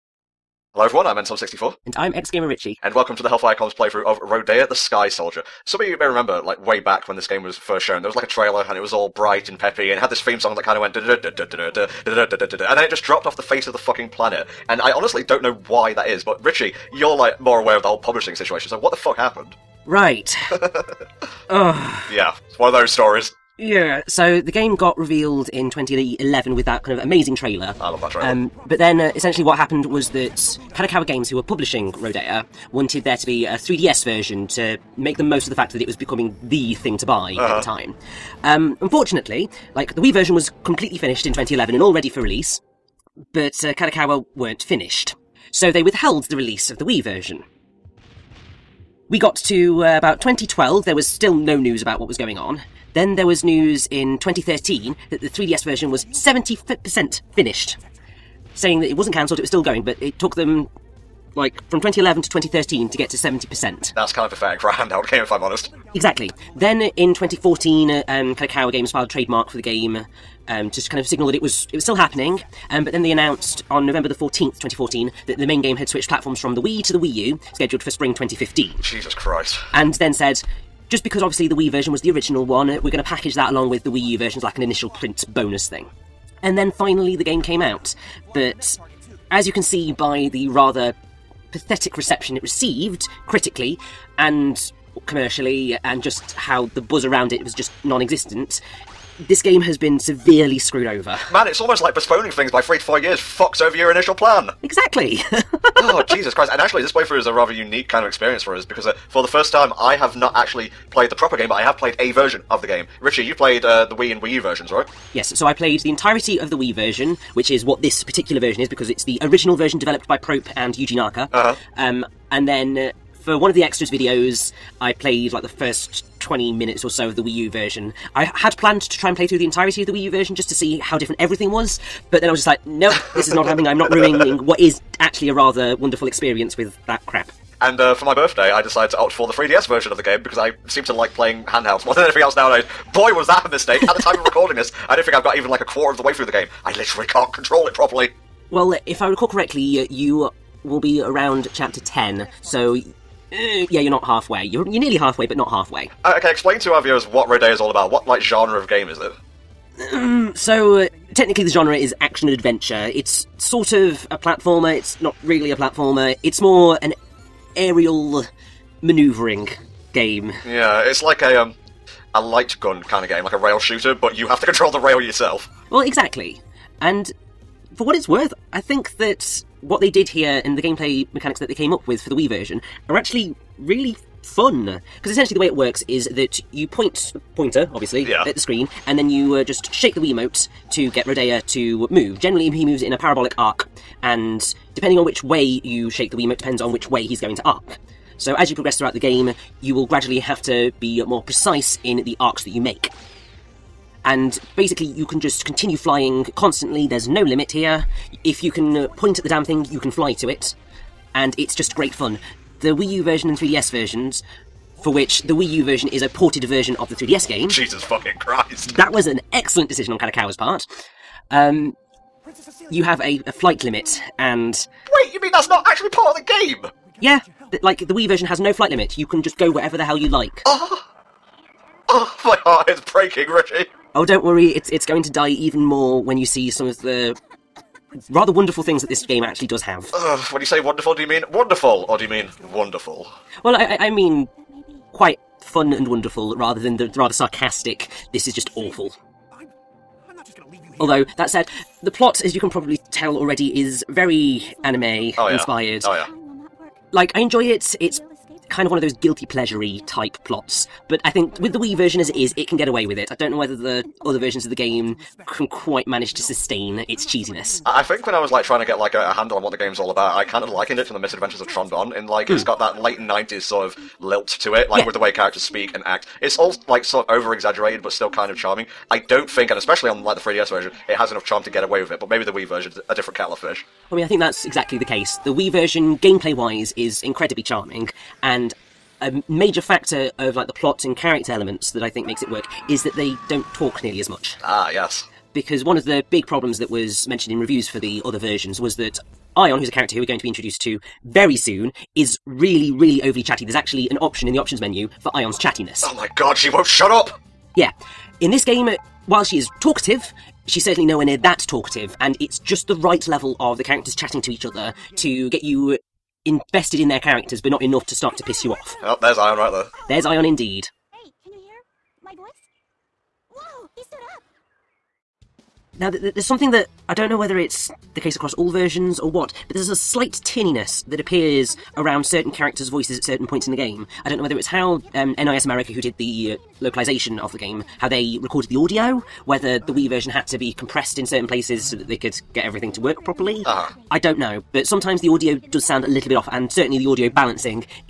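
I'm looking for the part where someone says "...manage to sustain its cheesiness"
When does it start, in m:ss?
4:25.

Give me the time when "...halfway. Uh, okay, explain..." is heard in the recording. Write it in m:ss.
2:35.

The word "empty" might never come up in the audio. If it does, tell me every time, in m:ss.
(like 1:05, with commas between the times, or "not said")
not said.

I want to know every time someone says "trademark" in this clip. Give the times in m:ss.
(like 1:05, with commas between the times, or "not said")
1:09.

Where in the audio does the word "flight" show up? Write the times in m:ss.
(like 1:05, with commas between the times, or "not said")
3:43, 3:48.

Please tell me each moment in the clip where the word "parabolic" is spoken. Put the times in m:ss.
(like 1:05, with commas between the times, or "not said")
3:12.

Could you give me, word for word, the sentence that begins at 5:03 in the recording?
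There's actually an option in the options menu for Ion's chattiness.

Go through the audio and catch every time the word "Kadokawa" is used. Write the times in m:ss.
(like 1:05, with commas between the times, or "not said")
0:30, 0:43, 1:08, 3:39.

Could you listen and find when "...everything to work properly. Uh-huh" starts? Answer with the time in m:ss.
5:42.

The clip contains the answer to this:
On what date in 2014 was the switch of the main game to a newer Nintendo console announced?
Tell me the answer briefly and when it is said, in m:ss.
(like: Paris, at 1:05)
November 14, 2014, at 1:13.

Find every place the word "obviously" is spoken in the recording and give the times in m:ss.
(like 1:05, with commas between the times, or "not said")
1:21, 3:07.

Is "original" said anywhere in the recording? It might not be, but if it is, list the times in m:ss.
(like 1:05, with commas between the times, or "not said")
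1:22, 1:59.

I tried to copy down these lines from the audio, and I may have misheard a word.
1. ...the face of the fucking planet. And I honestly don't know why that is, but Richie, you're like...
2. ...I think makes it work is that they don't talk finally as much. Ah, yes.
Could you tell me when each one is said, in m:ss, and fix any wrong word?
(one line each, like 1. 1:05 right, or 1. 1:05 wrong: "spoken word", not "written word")
1. 0:13 right
2. 4:51 wrong: "nearly", not "finally".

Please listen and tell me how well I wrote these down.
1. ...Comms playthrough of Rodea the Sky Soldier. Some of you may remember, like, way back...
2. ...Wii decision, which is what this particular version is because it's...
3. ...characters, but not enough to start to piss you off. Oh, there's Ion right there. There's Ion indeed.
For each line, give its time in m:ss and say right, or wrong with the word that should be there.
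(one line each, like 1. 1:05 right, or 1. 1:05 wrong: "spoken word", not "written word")
1. 0:03 right
2. 1:56 wrong: "version", not "decision"
3. 5:16 right.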